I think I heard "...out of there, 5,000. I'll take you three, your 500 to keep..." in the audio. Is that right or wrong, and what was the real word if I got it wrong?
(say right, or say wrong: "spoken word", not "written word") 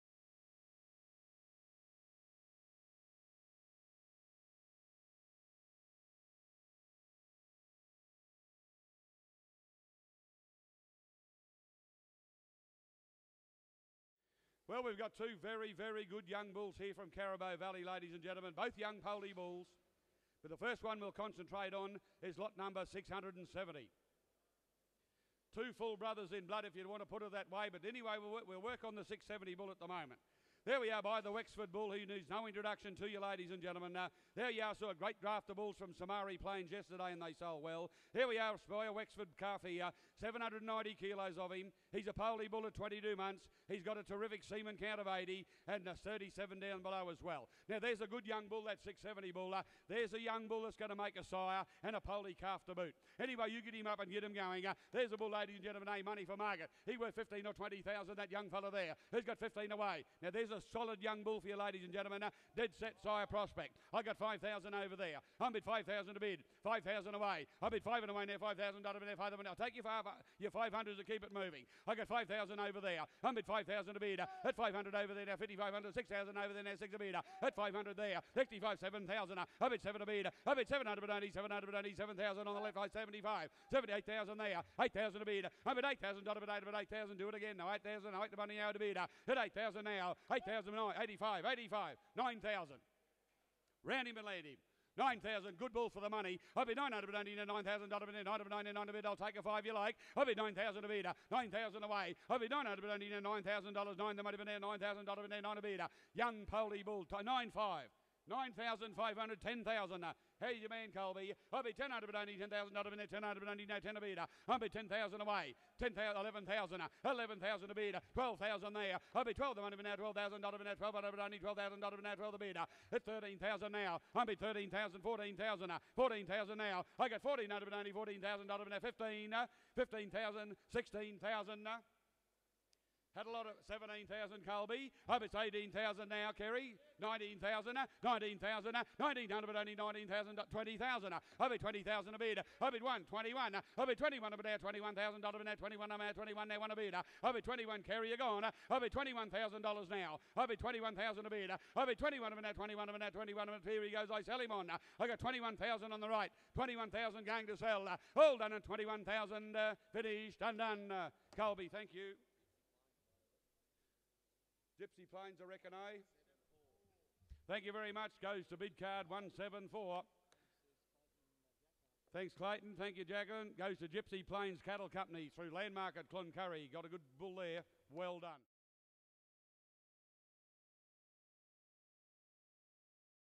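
wrong: "five", not "three".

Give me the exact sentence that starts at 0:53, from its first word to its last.
Anyway, you get him up and get him going.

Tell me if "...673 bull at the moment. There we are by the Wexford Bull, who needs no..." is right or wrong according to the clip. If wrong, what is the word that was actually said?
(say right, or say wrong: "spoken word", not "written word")
wrong: "670", not "673".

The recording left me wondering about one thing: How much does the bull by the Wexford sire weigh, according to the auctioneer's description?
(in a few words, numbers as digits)
790 kilos.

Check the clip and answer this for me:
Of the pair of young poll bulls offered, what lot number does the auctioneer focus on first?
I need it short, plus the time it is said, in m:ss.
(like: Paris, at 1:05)
670, at 0:22.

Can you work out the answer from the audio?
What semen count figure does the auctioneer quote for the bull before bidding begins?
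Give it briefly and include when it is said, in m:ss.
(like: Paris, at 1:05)
80, at 0:45.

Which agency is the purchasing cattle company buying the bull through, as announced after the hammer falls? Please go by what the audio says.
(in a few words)
Landmark.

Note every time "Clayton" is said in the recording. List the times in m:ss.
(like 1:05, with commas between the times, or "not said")
2:52.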